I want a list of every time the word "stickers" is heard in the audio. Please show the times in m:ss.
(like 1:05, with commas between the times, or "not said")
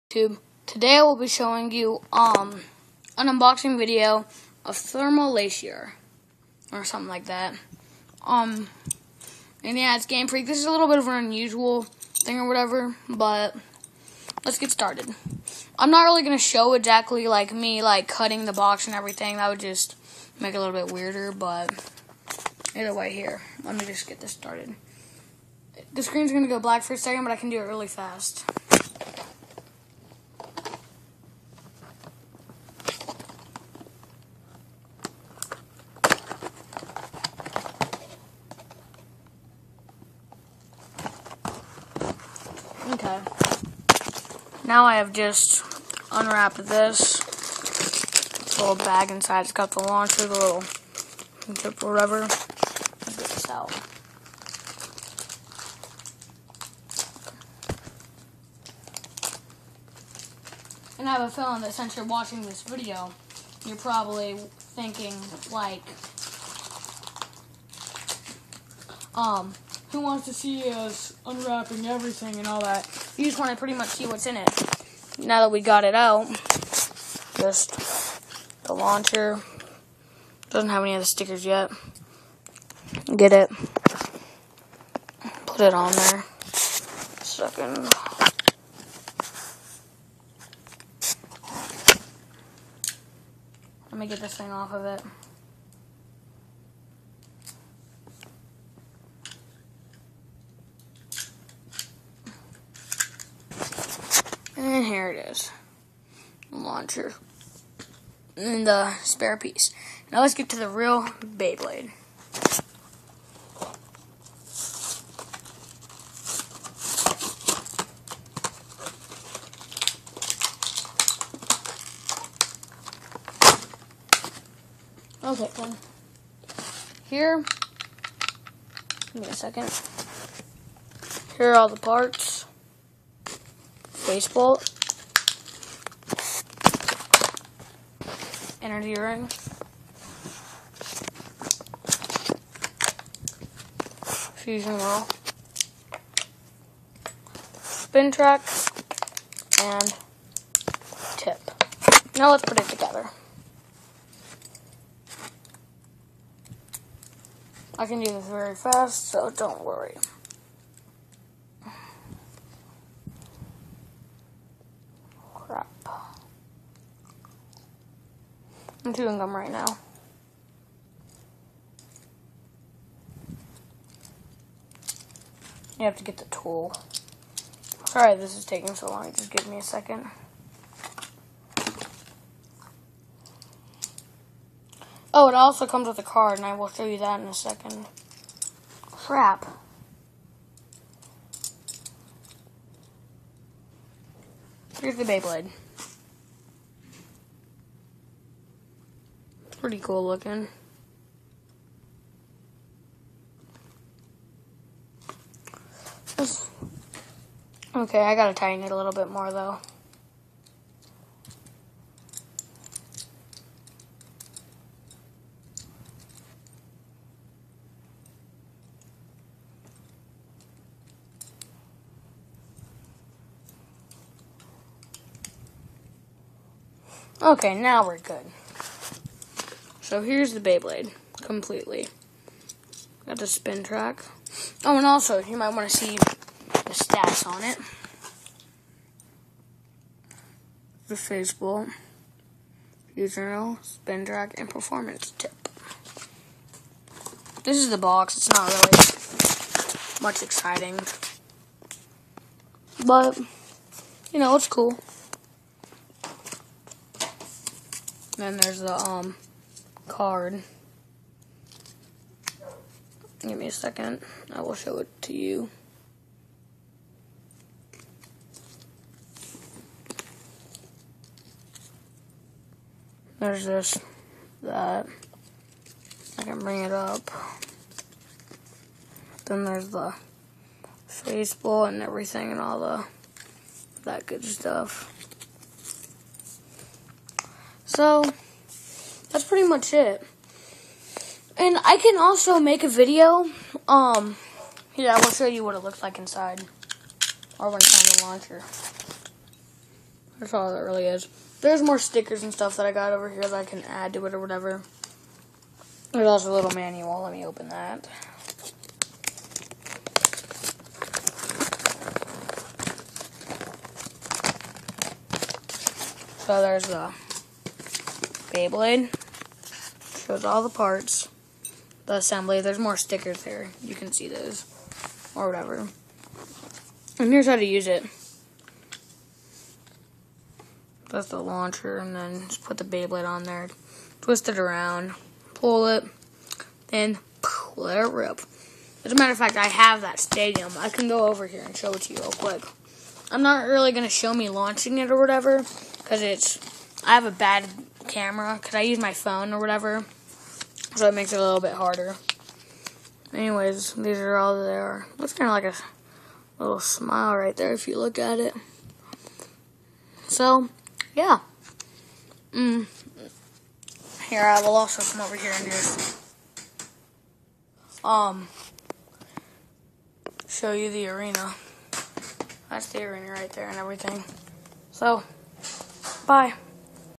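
1:21, 5:01, 5:22.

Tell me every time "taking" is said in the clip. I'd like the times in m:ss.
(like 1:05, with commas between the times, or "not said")
2:58.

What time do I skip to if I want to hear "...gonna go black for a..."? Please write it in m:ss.
0:26.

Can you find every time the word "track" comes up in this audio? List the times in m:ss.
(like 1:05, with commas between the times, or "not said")
2:28, 3:53, 4:04.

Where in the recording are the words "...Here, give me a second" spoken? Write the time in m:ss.
2:07.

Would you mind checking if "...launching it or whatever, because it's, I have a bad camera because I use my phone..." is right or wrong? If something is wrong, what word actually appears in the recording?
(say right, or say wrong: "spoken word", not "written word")
right.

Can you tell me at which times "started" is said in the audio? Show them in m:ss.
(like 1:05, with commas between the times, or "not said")
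0:14, 0:24.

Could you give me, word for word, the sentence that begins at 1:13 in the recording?
You just want to pretty much see what's in it.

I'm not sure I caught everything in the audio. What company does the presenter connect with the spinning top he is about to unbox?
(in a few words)
Game Freak.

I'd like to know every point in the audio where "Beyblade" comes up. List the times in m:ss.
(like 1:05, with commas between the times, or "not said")
1:51, 3:15, 3:50, 5:18, 5:32.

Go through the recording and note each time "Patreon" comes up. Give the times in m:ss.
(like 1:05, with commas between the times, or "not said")
not said.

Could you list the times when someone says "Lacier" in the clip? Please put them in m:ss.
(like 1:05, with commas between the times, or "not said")
0:05.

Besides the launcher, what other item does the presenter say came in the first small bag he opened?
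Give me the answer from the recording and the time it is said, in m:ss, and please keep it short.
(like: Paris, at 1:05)
spare piece, at 1:49.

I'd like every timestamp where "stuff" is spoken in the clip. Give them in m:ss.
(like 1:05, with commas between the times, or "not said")
4:44, 5:02.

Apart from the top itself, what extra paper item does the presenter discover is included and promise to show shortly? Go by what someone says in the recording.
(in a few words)
a card.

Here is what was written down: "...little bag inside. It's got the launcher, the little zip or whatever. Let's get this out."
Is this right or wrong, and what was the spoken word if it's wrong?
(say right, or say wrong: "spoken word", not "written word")
right.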